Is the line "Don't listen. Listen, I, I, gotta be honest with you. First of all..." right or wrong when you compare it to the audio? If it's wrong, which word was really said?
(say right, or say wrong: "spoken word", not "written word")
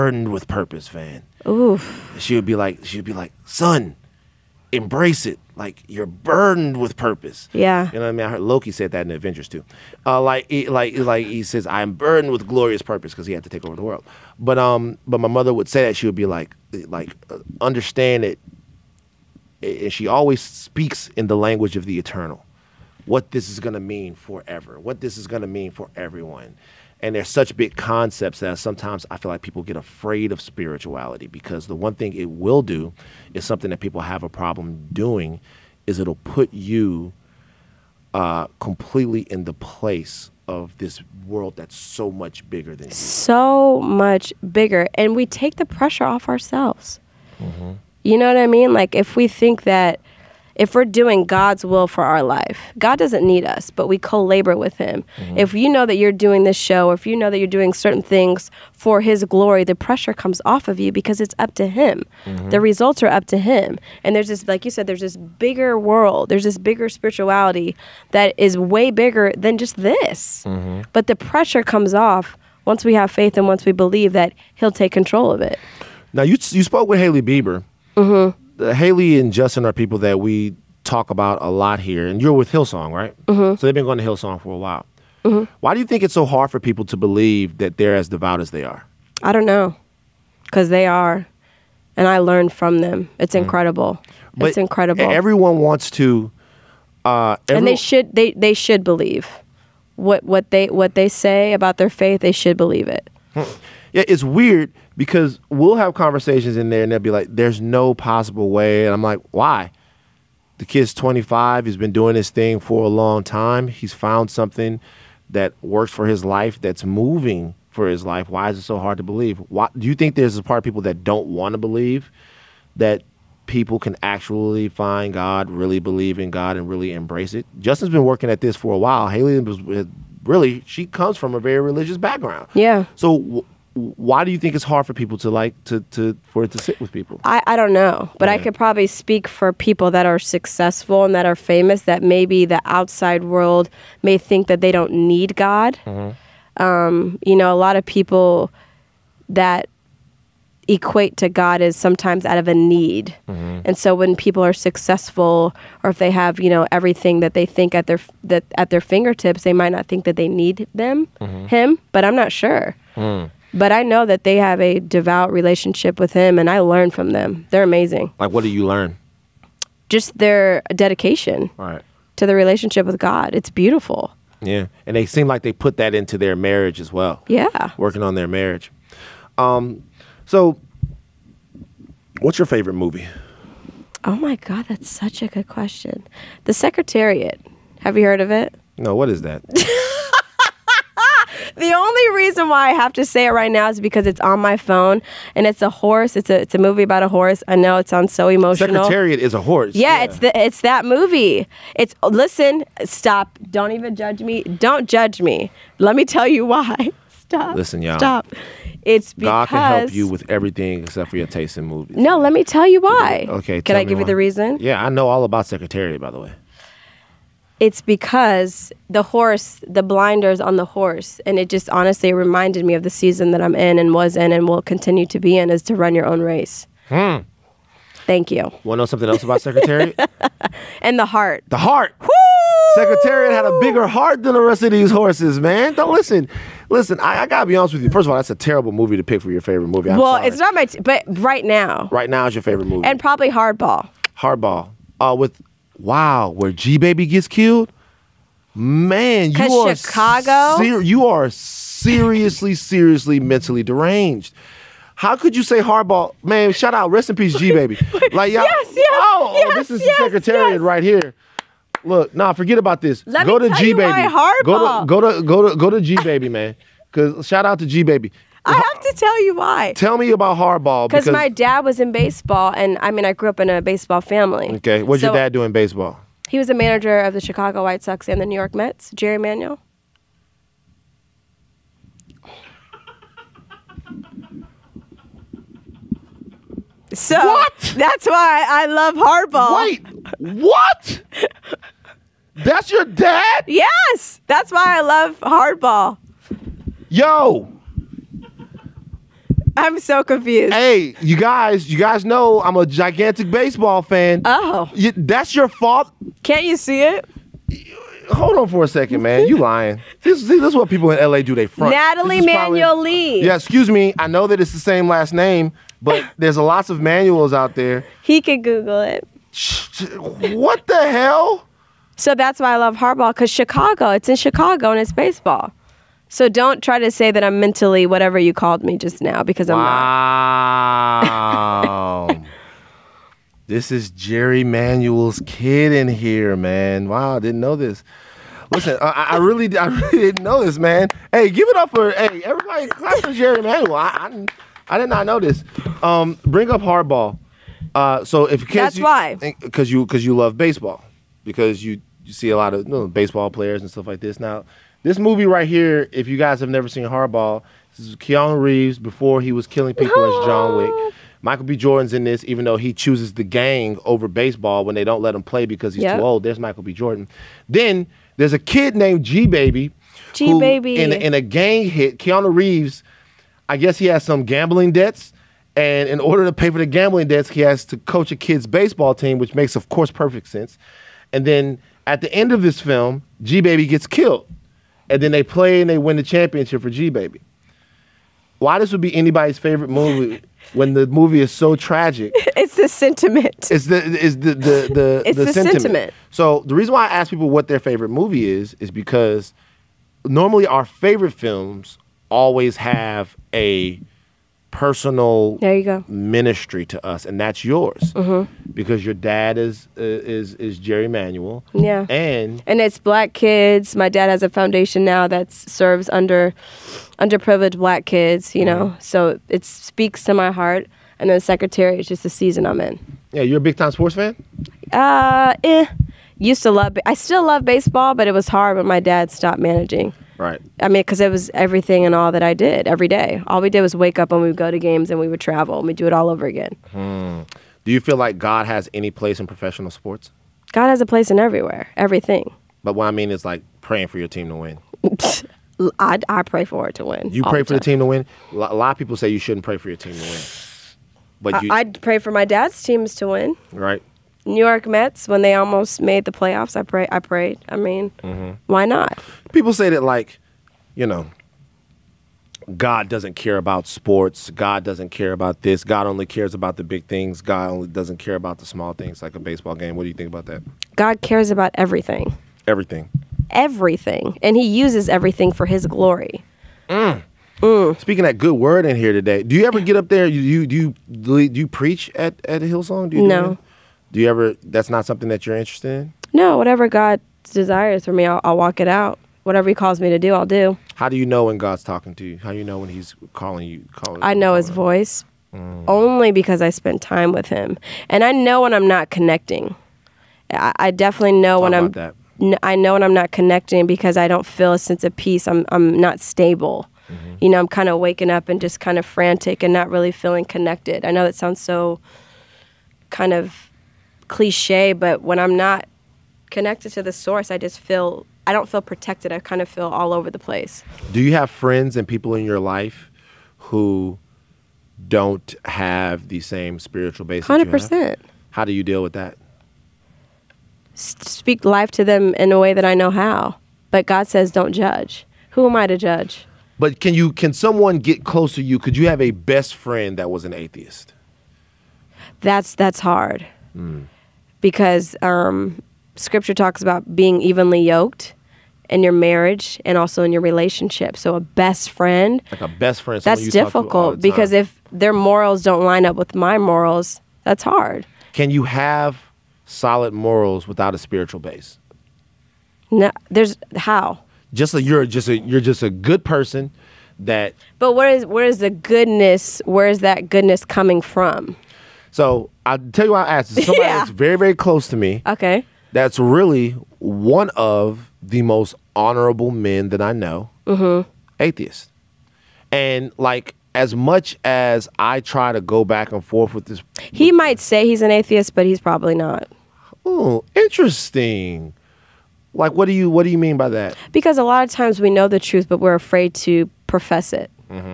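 right.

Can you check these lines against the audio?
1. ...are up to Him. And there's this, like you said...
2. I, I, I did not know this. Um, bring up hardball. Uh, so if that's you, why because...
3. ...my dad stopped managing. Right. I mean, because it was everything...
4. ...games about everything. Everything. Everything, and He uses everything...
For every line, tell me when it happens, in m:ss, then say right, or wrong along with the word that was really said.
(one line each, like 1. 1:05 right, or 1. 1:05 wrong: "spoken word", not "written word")
1. 1:03 right
2. 5:43 right
3. 7:08 right
4. 7:51 wrong: "cares", not "games".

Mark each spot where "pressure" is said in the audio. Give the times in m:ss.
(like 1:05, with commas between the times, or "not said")
0:45, 0:59, 1:11.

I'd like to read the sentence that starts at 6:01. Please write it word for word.
Jordan's in this, even though he chooses the gang over baseball when they don't let him play because he's yep.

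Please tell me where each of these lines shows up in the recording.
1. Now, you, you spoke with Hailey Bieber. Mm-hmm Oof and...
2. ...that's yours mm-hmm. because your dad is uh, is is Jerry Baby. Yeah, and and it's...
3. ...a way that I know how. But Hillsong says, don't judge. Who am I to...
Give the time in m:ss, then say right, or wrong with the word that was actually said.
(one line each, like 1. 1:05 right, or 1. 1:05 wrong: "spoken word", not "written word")
1. 1:16 wrong: "Hailey", not "Oof"
2. 6:47 wrong: "Manuel", not "Baby"
3. 8:52 wrong: "God", not "Hillsong".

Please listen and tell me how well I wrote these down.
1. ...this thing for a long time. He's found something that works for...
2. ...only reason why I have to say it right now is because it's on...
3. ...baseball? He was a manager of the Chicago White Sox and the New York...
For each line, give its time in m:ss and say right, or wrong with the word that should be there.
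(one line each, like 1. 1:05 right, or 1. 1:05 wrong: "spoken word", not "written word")
1. 1:52 right
2. 3:11 right
3. 4:35 right.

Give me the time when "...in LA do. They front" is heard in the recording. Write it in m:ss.
5:10.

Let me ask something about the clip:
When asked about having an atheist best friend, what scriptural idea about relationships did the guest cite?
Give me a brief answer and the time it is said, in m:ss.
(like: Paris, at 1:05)
evenly yoked, at 9:07.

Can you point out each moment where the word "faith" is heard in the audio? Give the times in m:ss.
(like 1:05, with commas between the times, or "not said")
1:13, 1:41.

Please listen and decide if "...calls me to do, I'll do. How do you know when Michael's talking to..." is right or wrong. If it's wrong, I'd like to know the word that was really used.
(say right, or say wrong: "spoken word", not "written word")
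wrong: "God", not "Michael".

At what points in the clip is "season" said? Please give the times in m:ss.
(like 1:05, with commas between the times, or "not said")
3:42, 7:02.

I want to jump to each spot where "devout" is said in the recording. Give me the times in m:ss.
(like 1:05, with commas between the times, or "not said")
1:28, 2:44.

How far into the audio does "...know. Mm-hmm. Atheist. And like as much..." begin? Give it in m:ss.
9:39.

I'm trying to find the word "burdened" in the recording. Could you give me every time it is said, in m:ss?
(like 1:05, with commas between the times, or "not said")
0:06, 0:11.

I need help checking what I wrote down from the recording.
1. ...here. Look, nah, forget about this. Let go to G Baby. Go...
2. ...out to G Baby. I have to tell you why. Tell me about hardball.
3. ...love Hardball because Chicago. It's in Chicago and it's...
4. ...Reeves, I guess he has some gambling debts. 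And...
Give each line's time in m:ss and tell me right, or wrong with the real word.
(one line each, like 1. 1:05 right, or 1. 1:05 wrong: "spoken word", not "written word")
1. 4:20 right
2. 4:27 right
3. 5:22 right
4. 6:12 right.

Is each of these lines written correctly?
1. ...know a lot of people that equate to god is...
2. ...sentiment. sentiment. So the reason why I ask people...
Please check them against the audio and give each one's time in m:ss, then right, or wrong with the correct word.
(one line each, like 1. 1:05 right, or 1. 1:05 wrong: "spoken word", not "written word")
1. 2:27 right
2. 6:35 right.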